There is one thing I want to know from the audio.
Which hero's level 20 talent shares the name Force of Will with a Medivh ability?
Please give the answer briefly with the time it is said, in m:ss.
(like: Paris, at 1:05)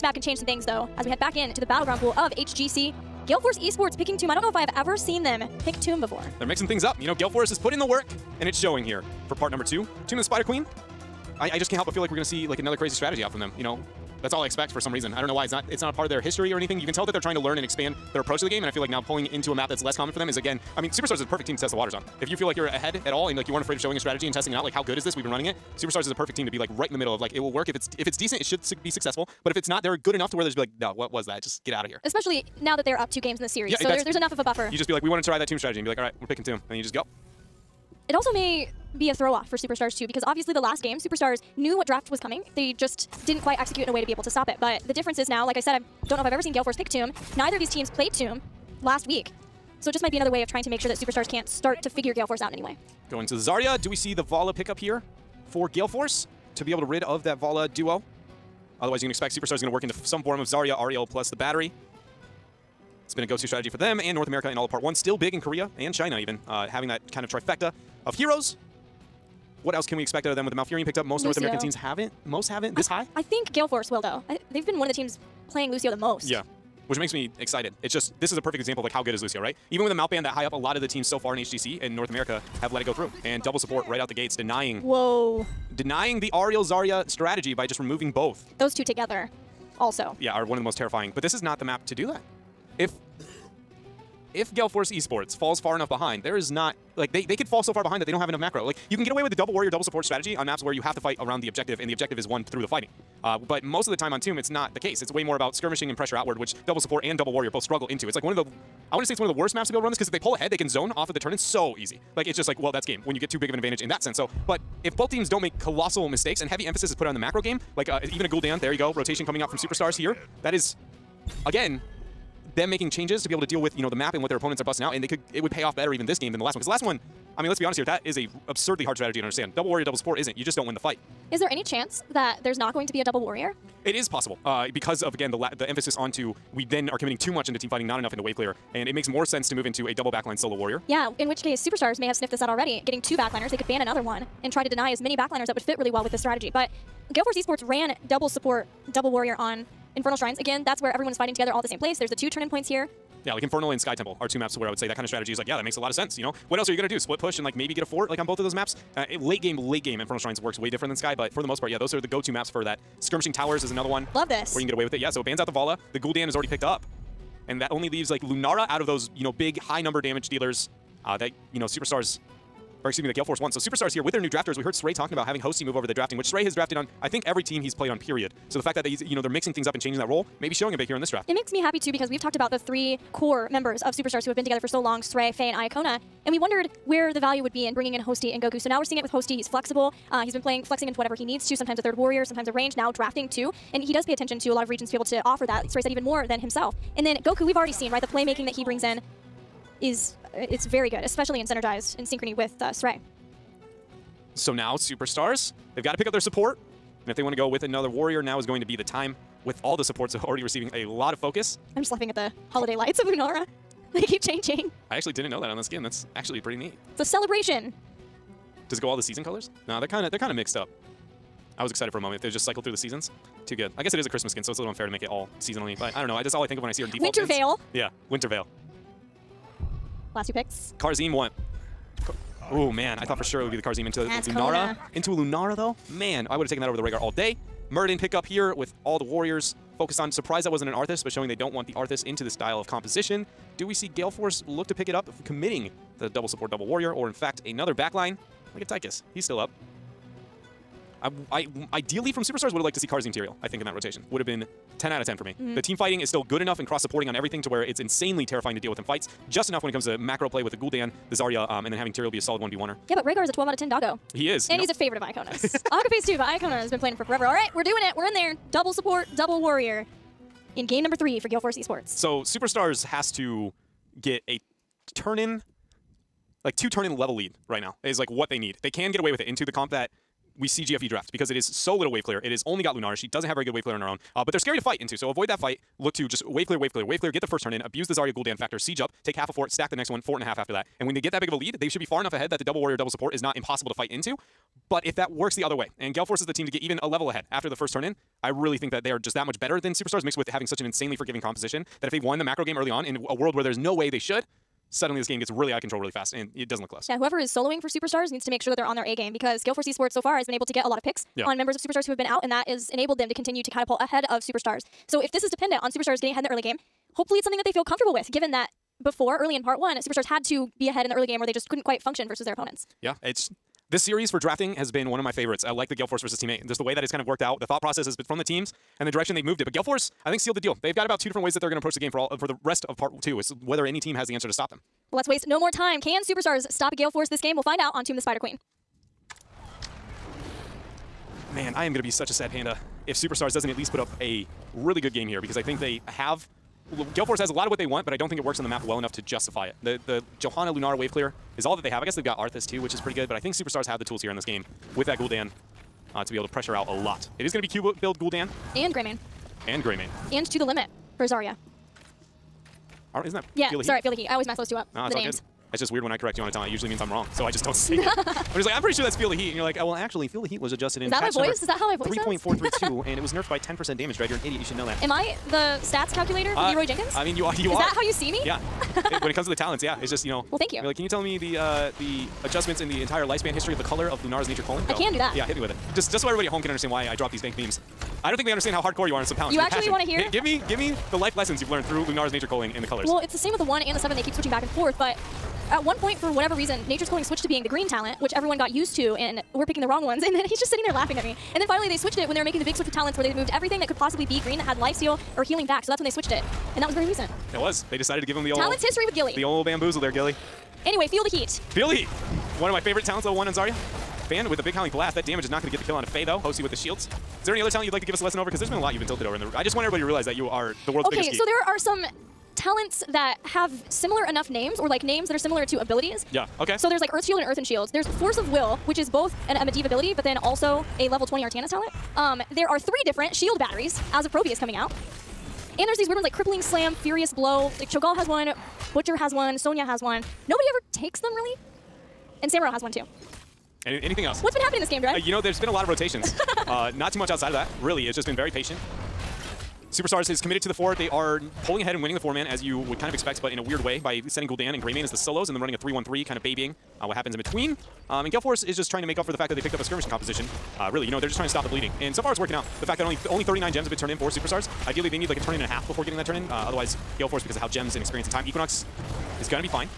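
Artanis, at 7:11.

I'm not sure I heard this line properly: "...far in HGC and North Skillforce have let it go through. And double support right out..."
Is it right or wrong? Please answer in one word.
wrong.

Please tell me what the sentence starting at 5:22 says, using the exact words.
Yeah, it's this series for drafting has been one of my favorites.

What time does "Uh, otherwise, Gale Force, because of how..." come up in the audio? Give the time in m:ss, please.
7:46.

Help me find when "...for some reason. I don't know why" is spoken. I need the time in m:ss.
0:14.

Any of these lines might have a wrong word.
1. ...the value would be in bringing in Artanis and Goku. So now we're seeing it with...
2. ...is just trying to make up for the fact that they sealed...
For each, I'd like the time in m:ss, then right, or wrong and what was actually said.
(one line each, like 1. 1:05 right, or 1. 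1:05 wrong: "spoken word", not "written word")
1. 3:07 wrong: "Hosty", not "Artanis"
2. 7:38 wrong: "picked", not "sealed".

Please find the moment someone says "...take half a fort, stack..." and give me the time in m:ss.
4:49.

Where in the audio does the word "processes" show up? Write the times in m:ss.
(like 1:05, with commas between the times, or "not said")
5:27.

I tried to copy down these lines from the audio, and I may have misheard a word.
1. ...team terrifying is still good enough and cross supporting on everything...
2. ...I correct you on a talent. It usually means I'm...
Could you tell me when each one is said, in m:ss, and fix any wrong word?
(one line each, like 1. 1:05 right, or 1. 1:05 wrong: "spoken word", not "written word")
1. 4:15 wrong: "fighting", not "terrifying"
2. 6:05 right.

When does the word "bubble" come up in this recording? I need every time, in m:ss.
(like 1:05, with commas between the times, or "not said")
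not said.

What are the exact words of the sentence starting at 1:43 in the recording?
Uh, but most of the time on Tomb, it's not the case.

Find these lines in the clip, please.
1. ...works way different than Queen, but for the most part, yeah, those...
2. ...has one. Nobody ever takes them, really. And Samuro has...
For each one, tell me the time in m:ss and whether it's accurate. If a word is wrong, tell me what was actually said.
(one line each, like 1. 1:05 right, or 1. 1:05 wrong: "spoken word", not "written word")
1. 2:40 wrong: "Sky", not "Queen"
2. 7:19 right.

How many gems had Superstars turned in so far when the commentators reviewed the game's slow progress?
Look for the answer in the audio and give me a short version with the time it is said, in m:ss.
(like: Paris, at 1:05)
39, at 7:43.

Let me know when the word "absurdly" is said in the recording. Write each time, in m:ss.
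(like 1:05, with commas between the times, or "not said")
2:08.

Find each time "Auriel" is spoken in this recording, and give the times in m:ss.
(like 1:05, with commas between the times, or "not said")
1:00, 1:26.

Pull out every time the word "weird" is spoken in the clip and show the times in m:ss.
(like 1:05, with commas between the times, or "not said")
6:05, 7:15, 7:33.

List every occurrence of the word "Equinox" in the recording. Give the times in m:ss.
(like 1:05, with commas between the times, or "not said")
7:48.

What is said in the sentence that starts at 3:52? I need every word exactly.
oh man, I thought for sure it would be the Kharazim into the Lunara.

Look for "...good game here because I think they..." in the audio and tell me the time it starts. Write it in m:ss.
5:44.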